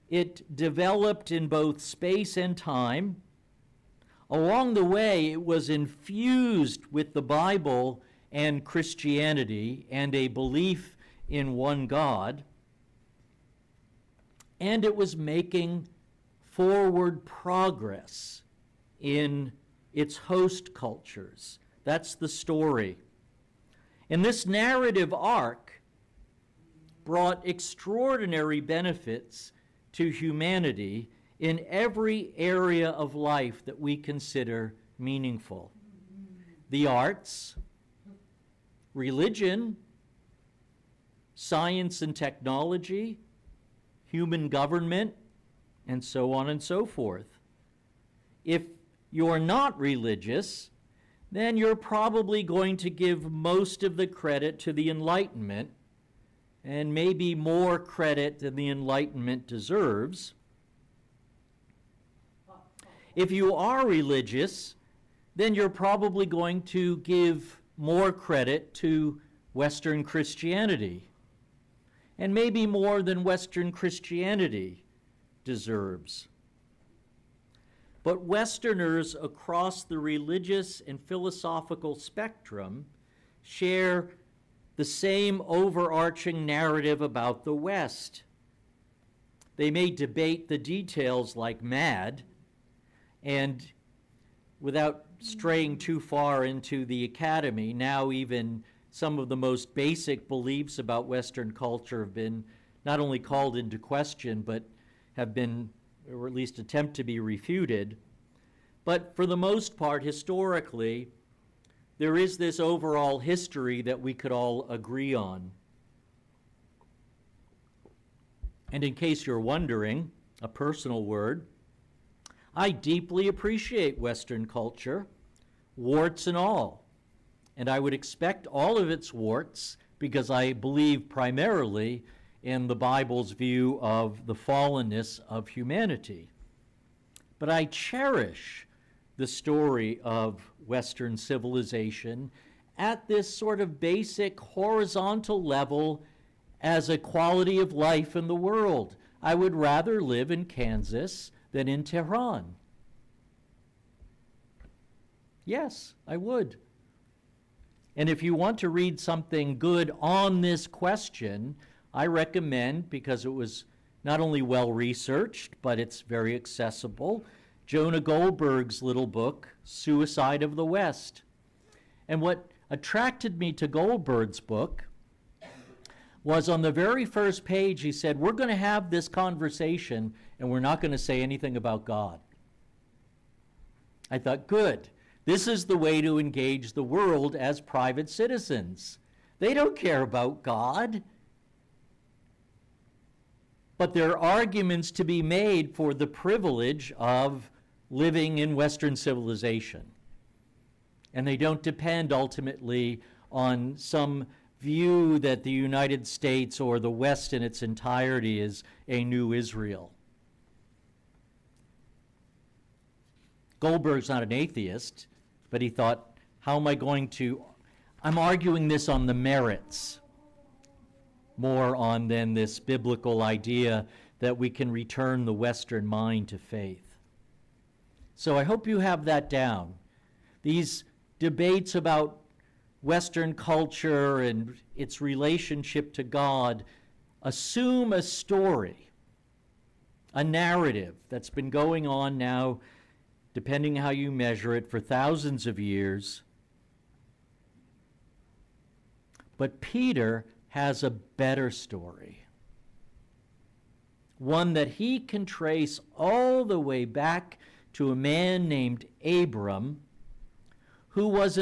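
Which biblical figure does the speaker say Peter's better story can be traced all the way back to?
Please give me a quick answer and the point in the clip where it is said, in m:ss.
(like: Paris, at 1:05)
Abram, at 4:19.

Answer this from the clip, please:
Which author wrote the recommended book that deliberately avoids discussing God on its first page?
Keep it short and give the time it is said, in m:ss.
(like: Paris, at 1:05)
Jonah Goldberg, at 2:47.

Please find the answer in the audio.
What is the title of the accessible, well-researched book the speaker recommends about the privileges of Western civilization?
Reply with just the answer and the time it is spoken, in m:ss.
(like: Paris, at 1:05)
Suicide of the West, at 2:49.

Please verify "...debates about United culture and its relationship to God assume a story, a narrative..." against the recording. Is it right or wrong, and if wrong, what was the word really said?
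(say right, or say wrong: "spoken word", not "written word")
wrong: "Western", not "United".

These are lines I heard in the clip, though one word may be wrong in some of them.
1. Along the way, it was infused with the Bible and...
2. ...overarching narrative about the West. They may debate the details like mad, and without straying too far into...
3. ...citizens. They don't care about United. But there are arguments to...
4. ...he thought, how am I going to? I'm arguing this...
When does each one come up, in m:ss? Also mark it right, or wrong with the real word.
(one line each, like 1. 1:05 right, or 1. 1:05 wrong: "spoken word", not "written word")
1. 0:04 right
2. 1:25 right
3. 3:08 wrong: "God", not "United"
4. 3:35 right.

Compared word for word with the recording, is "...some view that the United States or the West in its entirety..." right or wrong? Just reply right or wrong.
right.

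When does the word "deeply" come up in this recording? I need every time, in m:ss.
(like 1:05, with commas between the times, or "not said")
2:02.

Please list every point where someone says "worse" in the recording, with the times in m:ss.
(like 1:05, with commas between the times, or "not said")
not said.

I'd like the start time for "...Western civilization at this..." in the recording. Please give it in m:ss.
2:20.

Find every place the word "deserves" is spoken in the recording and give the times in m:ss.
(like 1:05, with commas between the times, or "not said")
0:59, 1:15.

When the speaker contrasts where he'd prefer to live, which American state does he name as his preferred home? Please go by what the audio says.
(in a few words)
Kansas.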